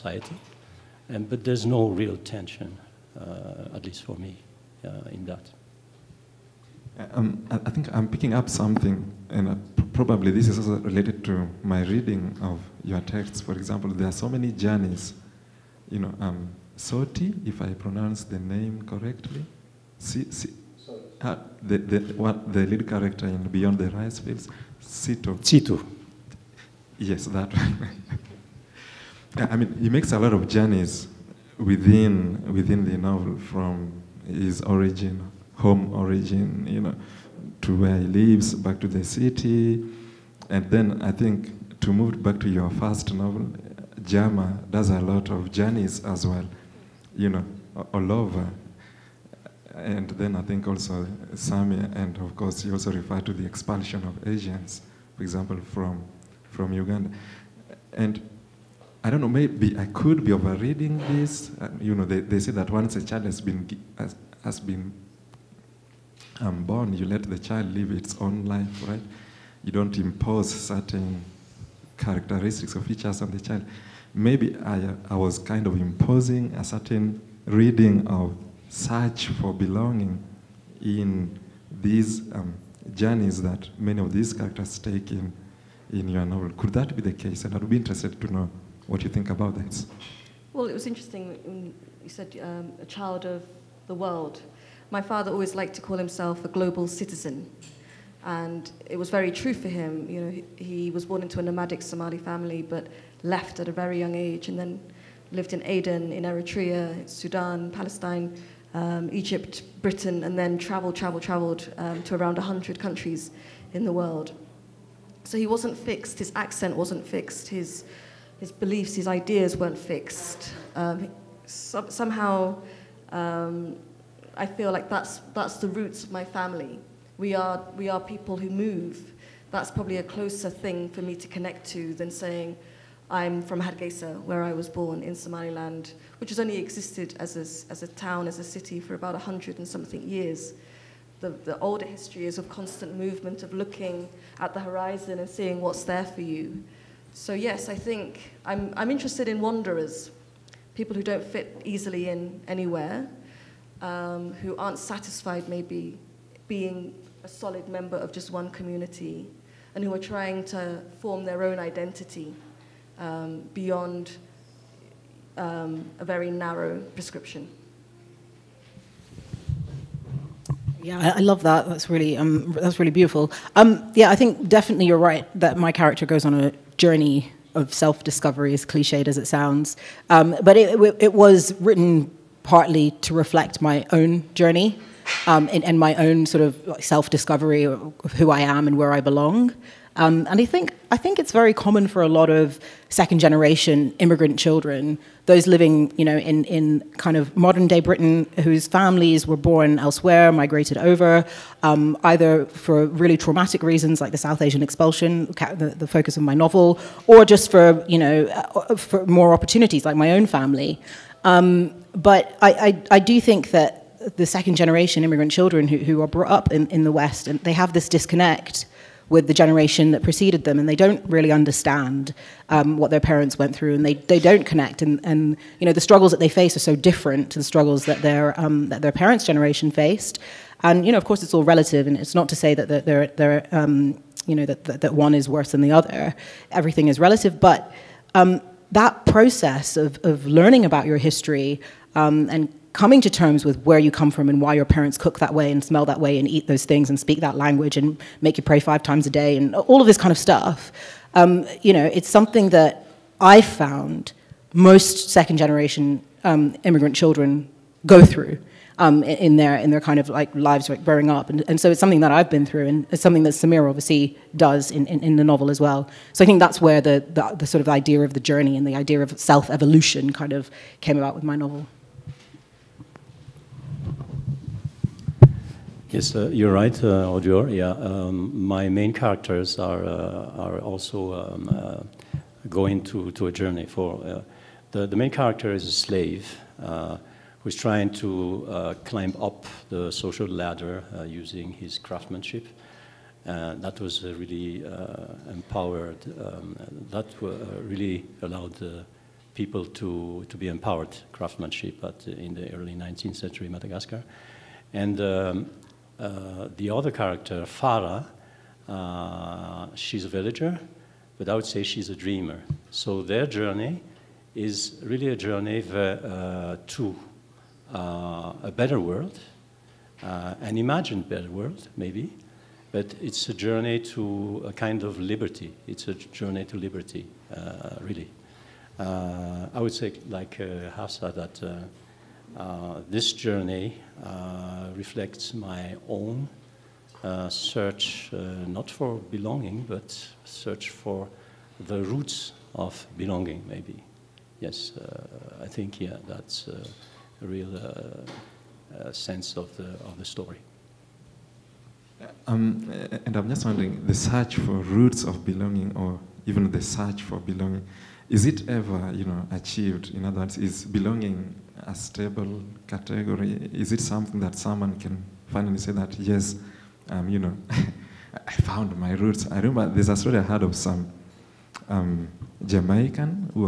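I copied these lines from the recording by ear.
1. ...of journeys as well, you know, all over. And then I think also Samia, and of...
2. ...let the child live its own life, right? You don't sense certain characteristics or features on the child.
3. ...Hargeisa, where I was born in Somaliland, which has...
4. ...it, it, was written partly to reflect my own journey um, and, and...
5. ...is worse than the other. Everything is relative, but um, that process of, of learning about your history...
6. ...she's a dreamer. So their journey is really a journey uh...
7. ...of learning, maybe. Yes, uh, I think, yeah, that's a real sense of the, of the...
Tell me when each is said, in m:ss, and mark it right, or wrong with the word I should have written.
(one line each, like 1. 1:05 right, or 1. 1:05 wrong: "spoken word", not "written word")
1. 0:45 right
2. 1:07 wrong: "impose", not "sense"
3. 2:13 right
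4. 3:00 right
5. 3:55 right
6. 5:11 right
7. 5:42 wrong: "belonging", not "learning".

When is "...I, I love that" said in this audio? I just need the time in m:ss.
2:51.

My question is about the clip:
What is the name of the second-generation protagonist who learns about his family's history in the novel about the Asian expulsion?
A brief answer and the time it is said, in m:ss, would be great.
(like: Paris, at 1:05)
Sameer, at 4:23.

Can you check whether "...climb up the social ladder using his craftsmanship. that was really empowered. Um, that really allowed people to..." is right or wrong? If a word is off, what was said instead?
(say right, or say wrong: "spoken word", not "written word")
right.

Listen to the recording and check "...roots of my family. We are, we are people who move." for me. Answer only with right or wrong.
right.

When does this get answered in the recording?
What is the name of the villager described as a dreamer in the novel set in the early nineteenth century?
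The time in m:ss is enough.
5:07.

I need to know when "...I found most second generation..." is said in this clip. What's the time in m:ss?
4:13.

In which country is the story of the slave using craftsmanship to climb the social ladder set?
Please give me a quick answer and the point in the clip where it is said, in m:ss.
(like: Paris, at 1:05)
Madagascar, at 5:03.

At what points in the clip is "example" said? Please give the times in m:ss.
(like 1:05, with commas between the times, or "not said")
0:13, 0:55.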